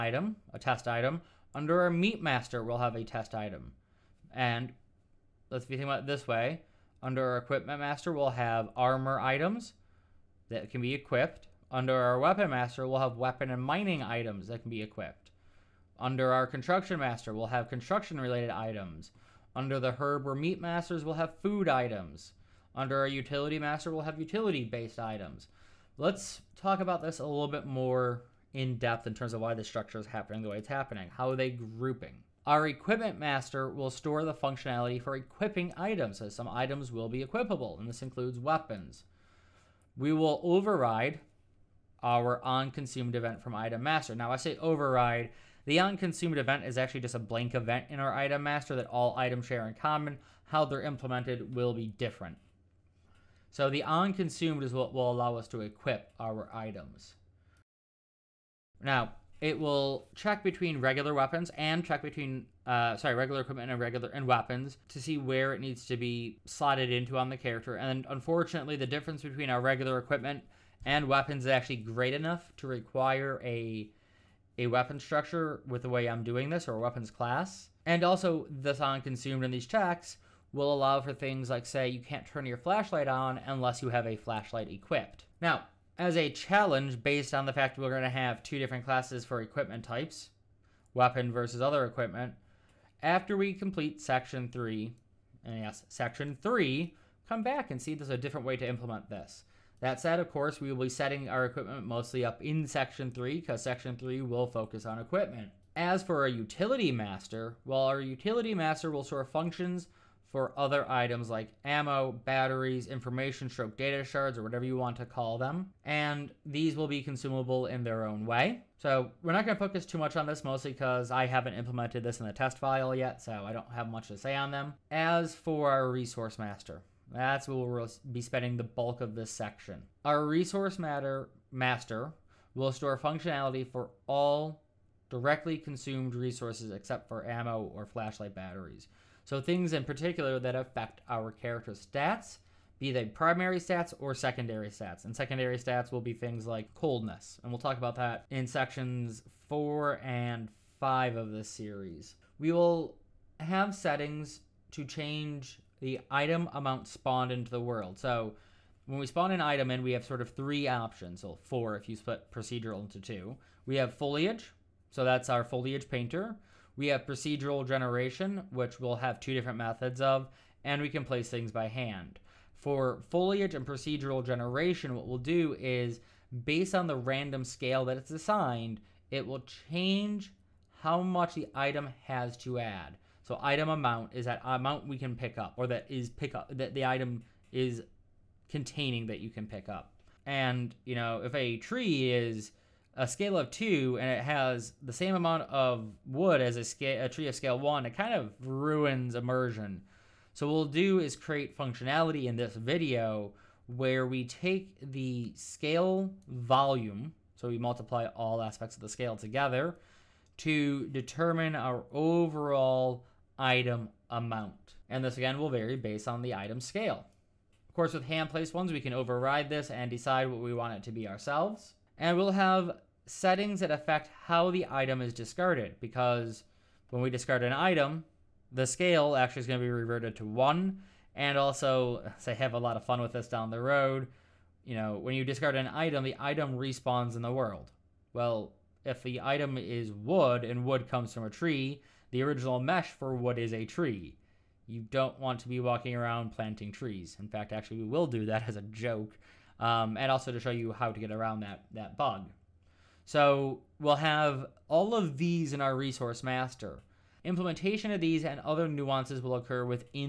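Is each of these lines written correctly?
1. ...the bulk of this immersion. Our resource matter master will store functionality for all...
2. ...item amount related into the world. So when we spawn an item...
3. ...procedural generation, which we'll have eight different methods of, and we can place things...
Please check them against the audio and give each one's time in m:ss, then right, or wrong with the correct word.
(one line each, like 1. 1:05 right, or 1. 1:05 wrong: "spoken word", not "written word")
1. 2:08 wrong: "section", not "immersion"
2. 2:36 wrong: "spawned", not "related"
3. 2:47 wrong: "two", not "eight".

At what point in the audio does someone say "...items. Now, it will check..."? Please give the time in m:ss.
0:56.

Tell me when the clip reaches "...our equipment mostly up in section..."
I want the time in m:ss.
1:41.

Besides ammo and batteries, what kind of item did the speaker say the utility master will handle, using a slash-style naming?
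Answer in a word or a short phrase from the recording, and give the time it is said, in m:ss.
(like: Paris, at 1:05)
data shards, at 1:53.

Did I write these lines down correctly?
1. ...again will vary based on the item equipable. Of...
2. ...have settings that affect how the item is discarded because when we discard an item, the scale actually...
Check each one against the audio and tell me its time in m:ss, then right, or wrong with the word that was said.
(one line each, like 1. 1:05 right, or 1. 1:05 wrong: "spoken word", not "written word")
1. 3:35 wrong: "scale", not "equipable"
2. 3:42 right.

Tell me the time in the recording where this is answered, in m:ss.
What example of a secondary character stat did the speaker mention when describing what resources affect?
2:26.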